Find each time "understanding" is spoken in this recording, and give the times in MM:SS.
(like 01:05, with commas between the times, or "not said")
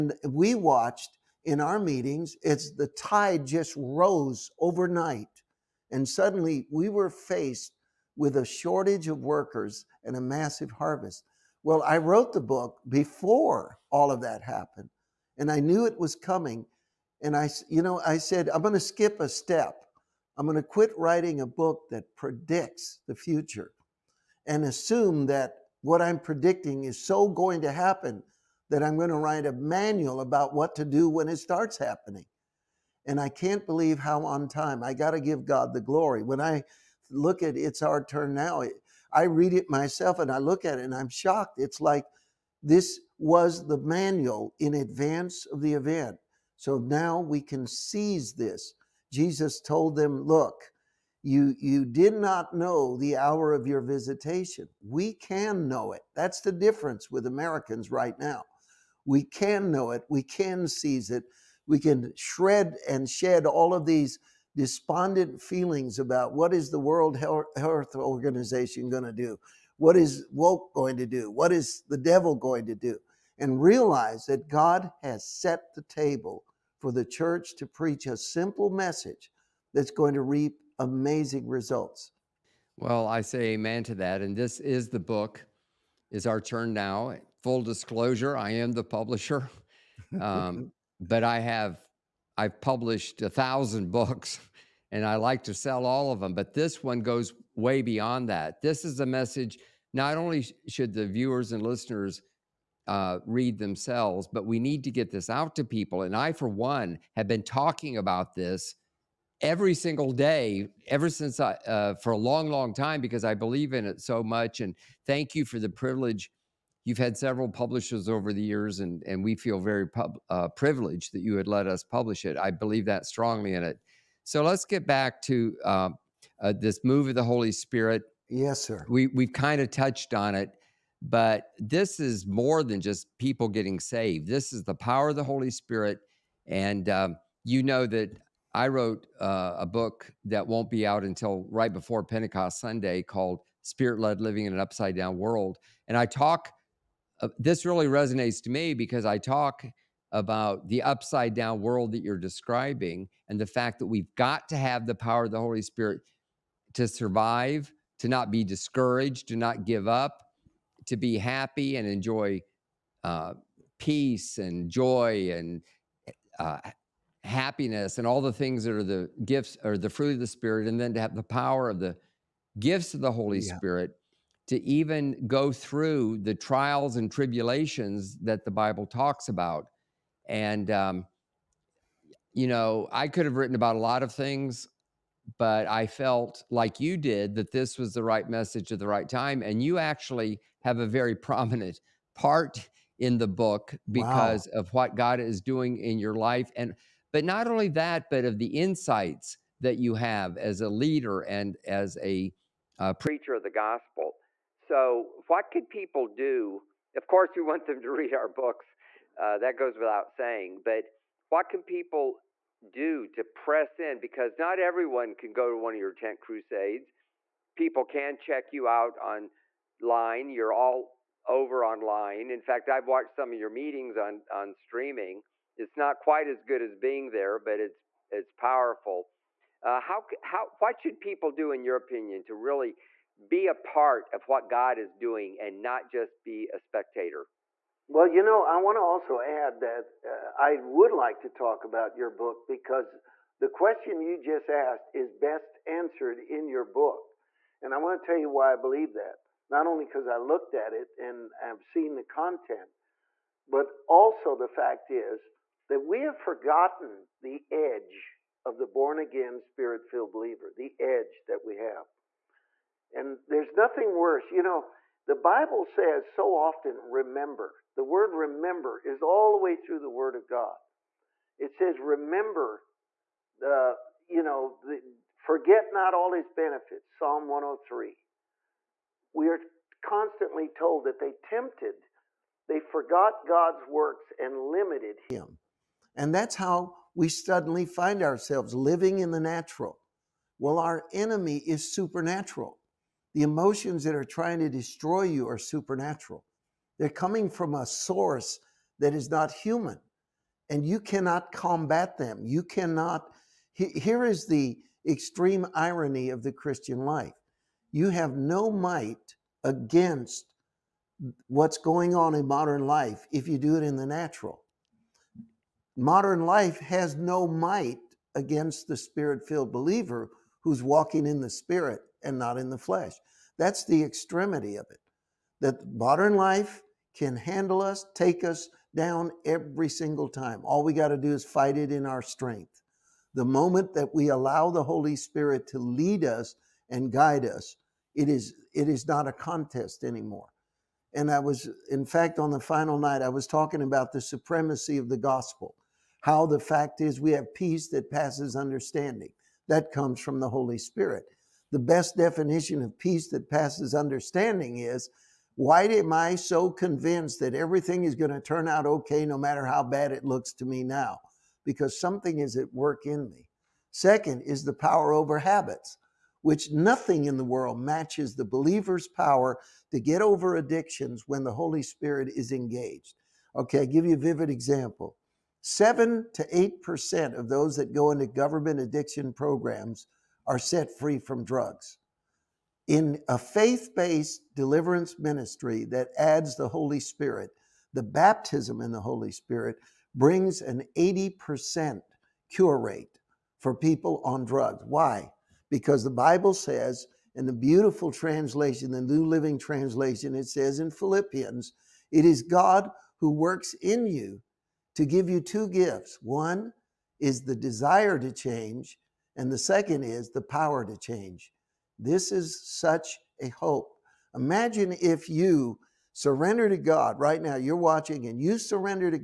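05:48, 05:53.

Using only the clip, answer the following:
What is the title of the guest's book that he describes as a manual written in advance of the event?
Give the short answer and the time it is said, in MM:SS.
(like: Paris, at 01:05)
It's Our Turn Now, at 00:37.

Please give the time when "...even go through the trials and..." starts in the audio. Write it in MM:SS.
02:54.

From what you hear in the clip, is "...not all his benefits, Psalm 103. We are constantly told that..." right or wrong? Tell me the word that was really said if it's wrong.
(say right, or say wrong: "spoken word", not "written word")
right.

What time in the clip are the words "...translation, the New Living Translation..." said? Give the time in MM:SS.
06:37.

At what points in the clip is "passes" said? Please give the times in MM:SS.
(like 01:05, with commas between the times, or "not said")
05:47, 05:53.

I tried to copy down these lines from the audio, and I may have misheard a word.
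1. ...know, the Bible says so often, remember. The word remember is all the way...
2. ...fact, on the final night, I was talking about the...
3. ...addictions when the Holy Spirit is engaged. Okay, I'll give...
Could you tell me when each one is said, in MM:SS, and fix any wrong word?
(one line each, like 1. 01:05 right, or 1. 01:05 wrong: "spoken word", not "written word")
1. 04:24 right
2. 05:41 right
3. 06:10 right.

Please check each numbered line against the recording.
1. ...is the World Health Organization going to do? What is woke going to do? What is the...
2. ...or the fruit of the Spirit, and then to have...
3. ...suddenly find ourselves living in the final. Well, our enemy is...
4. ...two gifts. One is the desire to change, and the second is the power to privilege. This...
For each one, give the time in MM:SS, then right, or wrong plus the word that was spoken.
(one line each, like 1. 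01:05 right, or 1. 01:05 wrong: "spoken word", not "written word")
1. 01:06 right
2. 02:49 right
3. 04:47 wrong: "natural", not "final"
4. 06:45 wrong: "change", not "privilege".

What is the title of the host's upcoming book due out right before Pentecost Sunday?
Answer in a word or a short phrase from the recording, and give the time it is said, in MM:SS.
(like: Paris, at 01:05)
Spirit Led Living in an Upside Down World, at 02:23.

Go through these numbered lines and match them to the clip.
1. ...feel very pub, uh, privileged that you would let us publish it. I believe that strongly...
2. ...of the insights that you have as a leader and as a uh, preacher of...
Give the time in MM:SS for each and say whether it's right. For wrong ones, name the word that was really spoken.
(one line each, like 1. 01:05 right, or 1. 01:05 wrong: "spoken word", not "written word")
1. 01:59 right
2. 03:18 right.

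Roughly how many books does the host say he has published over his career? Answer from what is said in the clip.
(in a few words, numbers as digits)
1000.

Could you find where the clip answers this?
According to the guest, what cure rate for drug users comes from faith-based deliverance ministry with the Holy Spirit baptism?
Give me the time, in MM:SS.
06:30.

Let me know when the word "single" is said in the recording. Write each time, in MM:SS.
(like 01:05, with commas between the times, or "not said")
01:49, 05:29.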